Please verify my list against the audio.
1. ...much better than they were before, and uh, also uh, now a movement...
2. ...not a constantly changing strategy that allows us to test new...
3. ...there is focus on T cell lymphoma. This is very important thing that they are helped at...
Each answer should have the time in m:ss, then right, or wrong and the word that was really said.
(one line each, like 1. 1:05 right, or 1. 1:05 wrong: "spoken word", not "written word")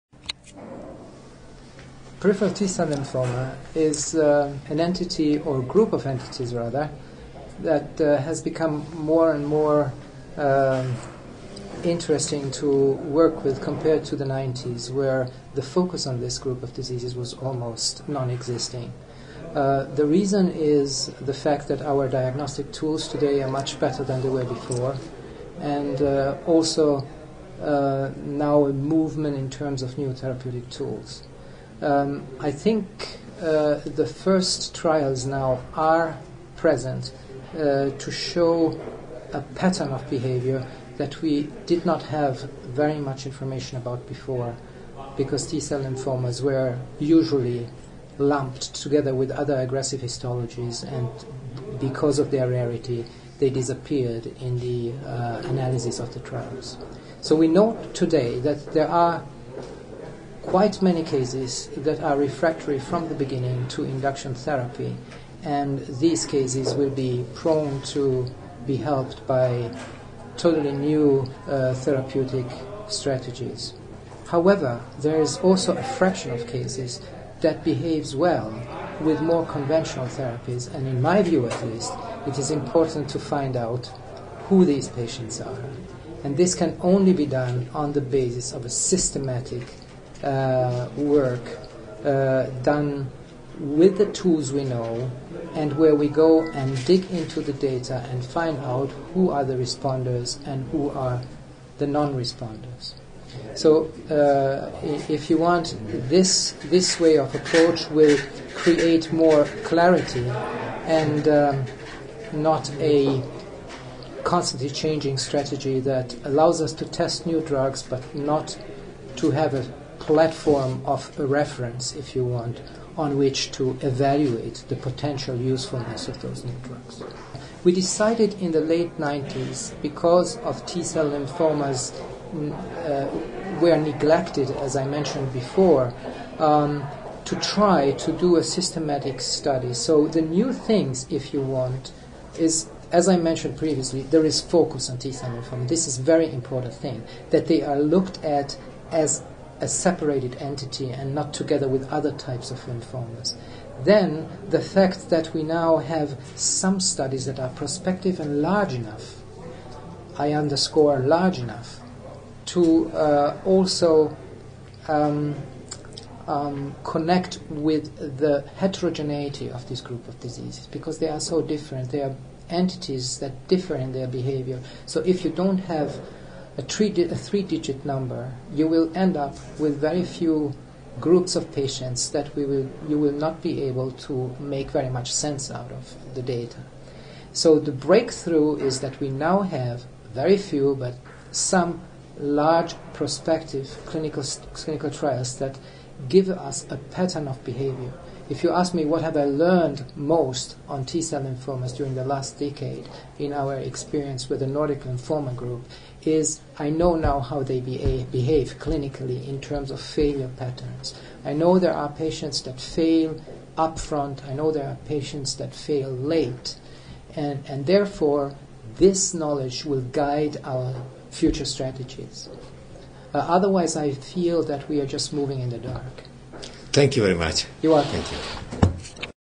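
1. 0:23 right
2. 1:52 right
3. 2:24 wrong: "looked", not "helped".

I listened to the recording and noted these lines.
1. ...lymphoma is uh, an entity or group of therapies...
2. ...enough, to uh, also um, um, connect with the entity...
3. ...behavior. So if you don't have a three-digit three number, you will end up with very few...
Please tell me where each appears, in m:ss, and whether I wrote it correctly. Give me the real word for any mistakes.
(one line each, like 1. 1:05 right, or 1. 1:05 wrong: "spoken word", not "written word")
1. 0:02 wrong: "entities", not "therapies"
2. 2:41 wrong: "heterogeneity", not "entity"
3. 2:54 right.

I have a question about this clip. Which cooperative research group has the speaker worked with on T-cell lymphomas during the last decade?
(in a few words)
Nordic lymphoma group.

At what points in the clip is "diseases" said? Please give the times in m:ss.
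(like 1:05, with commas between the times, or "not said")
0:16, 2:50.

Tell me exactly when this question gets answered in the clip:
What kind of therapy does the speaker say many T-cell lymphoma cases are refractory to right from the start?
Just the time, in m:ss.
1:03.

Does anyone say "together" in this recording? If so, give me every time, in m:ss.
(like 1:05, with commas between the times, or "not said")
0:48, 2:31.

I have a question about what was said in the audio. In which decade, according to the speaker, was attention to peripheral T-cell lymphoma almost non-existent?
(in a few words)
the 90s.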